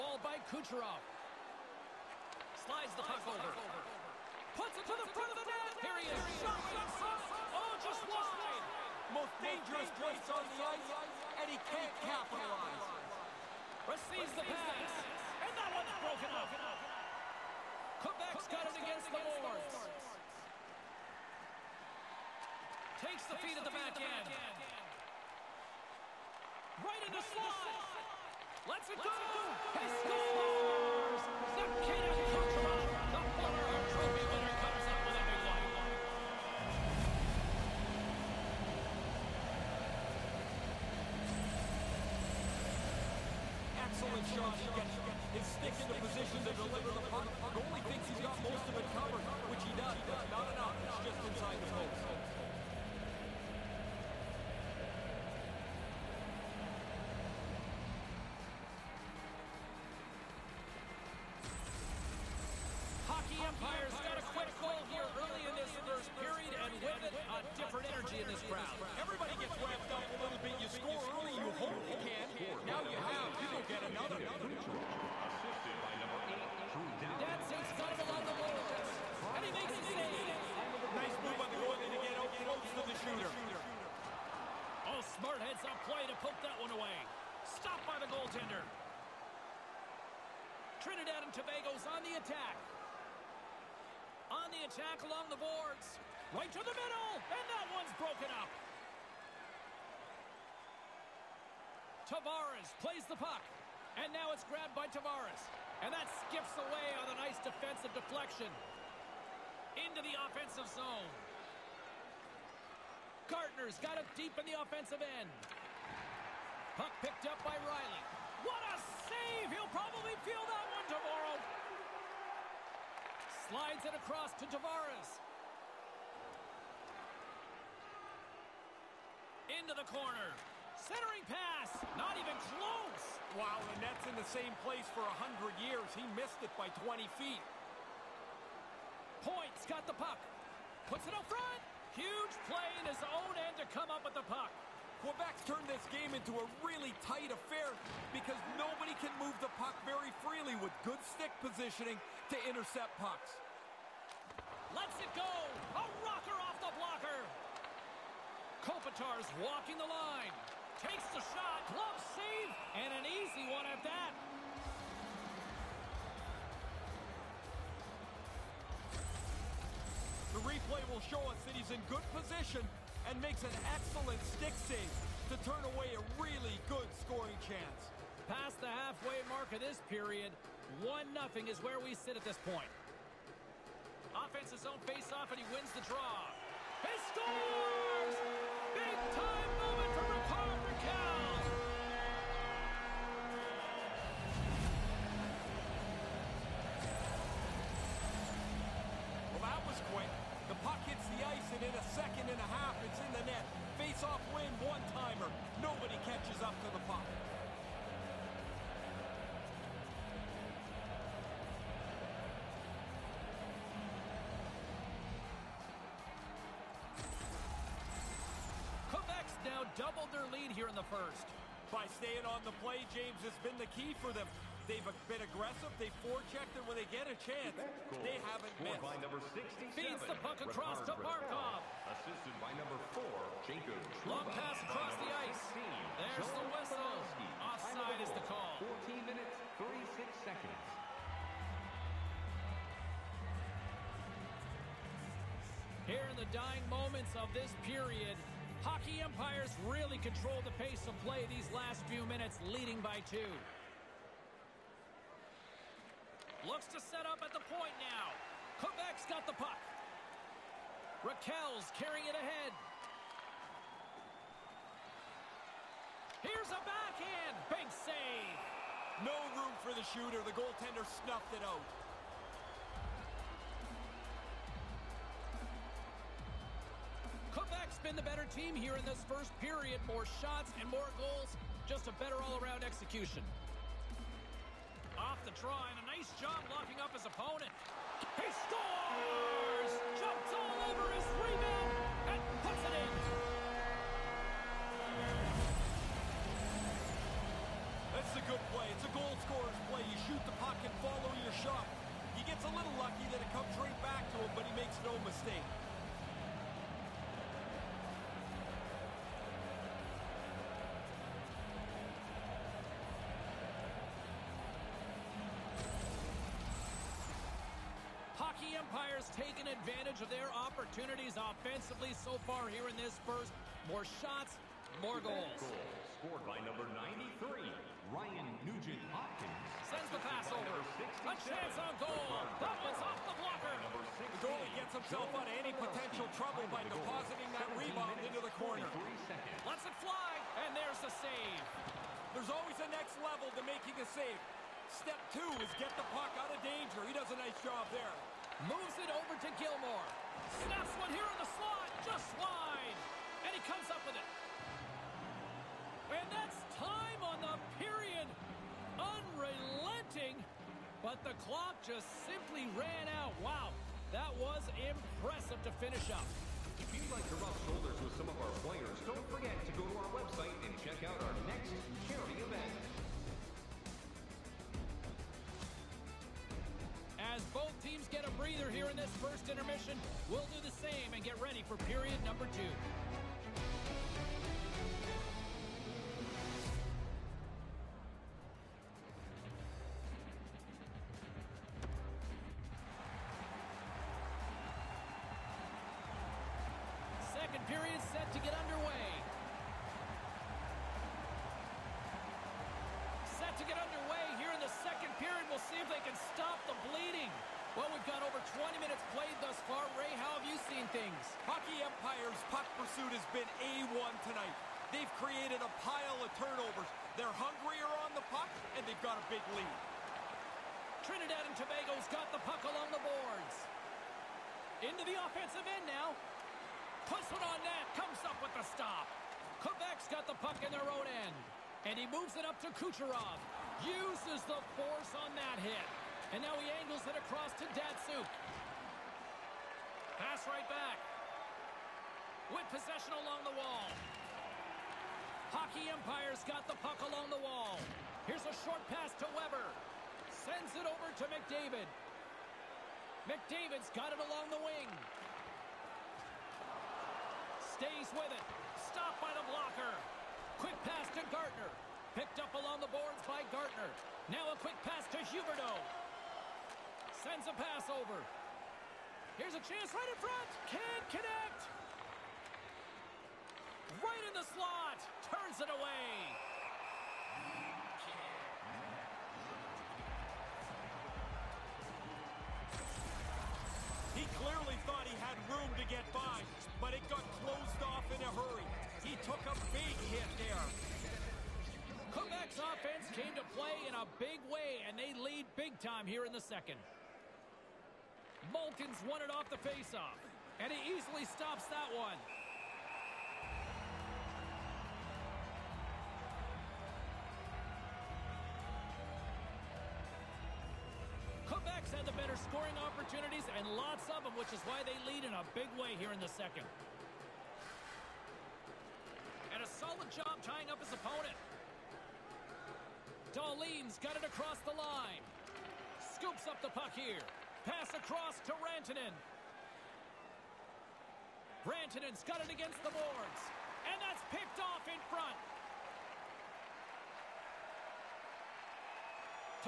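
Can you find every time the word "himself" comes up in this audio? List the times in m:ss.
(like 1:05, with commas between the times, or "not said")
5:34.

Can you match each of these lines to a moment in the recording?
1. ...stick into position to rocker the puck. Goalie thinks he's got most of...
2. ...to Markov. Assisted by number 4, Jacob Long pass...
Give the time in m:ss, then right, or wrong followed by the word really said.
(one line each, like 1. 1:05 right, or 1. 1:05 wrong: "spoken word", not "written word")
1. 0:45 wrong: "deliver", not "rocker"
2. 3:50 right.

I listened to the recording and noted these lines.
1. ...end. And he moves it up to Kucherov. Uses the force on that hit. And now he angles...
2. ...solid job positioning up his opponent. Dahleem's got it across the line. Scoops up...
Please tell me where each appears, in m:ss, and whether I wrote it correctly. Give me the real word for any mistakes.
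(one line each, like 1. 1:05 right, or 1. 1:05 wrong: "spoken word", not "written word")
1. 7:11 right
2. 8:39 wrong: "tying", not "positioning".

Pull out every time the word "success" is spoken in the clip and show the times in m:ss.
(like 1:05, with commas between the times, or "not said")
not said.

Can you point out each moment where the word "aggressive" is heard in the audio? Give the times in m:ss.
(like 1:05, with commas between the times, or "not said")
3:45.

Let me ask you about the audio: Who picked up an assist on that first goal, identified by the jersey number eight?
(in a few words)
Drew Doughty.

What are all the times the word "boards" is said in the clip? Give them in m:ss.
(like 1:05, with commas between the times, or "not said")
0:19, 1:18, 1:35, 7:02, 7:42, 8:52.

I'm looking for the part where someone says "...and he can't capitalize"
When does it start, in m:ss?
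0:11.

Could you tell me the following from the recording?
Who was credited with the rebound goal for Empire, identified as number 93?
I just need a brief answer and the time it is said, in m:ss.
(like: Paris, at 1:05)
Ryan Nugent Hopkins, at 5:27.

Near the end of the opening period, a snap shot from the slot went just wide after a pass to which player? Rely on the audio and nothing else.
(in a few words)
Gilmore.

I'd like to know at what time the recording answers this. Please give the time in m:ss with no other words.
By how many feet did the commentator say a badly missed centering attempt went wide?
2:16.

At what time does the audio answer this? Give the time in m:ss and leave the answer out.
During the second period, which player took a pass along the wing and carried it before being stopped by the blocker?
7:33.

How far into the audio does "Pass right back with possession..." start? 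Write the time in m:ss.
7:20.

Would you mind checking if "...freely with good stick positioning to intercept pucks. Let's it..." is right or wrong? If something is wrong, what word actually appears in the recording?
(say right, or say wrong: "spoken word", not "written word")
right.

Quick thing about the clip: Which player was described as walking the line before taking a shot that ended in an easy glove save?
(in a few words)
Kopitar.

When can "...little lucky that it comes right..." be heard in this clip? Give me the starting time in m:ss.
5:02.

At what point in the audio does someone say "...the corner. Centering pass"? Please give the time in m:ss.
2:09.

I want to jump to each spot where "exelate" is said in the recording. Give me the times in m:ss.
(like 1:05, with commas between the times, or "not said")
not said.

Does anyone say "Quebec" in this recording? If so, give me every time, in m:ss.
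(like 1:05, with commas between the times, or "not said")
0:18, 2:25, 4:18, 7:09, 8:11.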